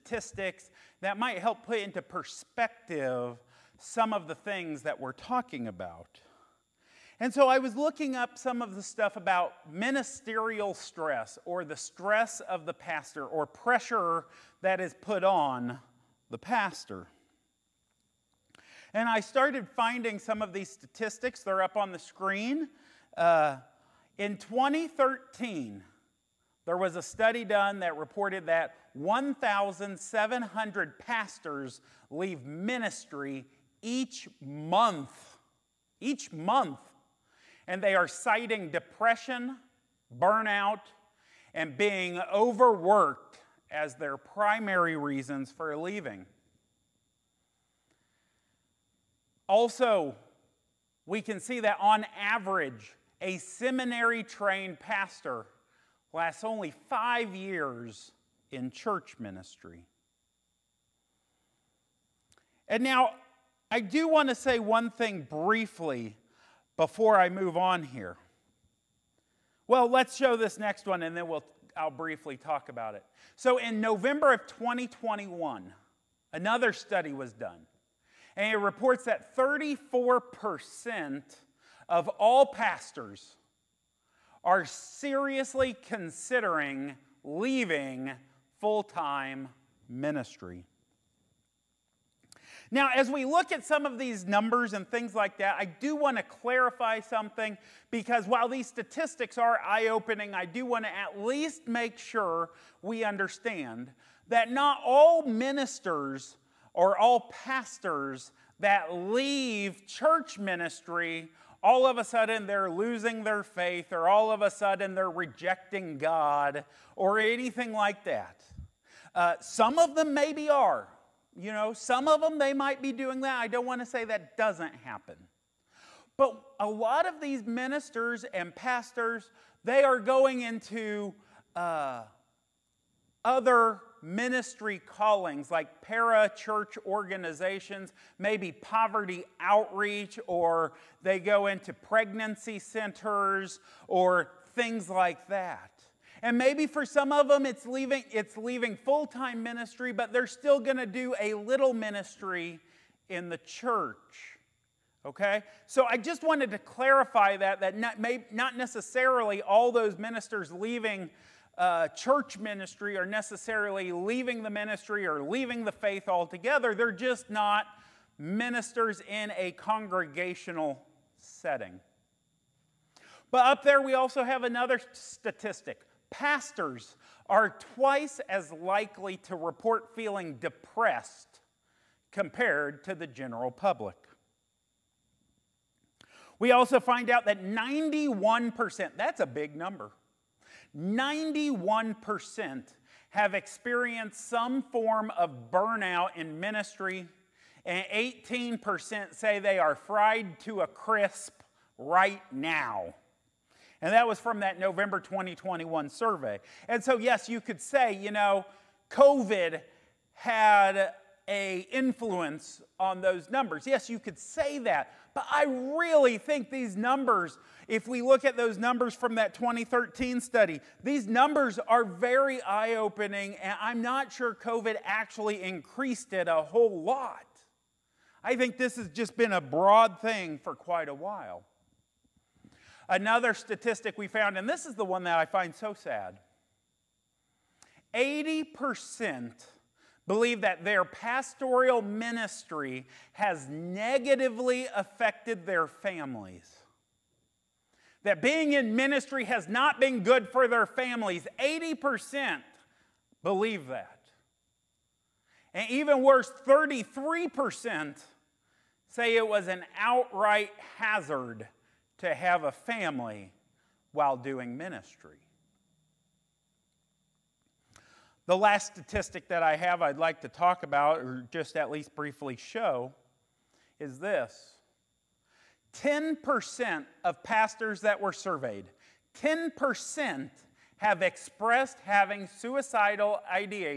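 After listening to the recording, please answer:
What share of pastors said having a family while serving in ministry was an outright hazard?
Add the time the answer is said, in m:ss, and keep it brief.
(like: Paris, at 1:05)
33%, at 4:16.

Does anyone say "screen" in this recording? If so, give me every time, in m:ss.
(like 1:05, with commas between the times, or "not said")
0:21.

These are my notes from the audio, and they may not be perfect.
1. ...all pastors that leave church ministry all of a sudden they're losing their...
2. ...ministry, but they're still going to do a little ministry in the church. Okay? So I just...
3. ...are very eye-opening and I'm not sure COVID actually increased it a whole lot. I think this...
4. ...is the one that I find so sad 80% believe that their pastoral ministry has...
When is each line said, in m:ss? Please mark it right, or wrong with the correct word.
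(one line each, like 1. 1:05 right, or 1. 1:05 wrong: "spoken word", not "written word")
1. 1:46 right
2. 2:29 right
3. 3:41 right
4. 3:54 right.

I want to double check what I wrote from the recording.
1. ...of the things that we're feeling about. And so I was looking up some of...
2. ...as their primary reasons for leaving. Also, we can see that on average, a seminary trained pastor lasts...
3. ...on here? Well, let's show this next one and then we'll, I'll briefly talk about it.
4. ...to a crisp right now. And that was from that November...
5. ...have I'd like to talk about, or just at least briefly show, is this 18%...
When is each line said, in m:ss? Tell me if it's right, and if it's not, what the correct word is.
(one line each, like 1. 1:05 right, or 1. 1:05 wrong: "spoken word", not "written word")
1. 0:04 wrong: "talking", not "feeling"
2. 0:43 right
3. 1:07 right
4. 3:20 right
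5. 4:29 wrong: "10", not "18".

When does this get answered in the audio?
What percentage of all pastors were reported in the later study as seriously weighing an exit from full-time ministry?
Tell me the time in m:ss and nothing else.
1:19.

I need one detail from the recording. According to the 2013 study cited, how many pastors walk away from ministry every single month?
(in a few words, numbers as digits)
1,700.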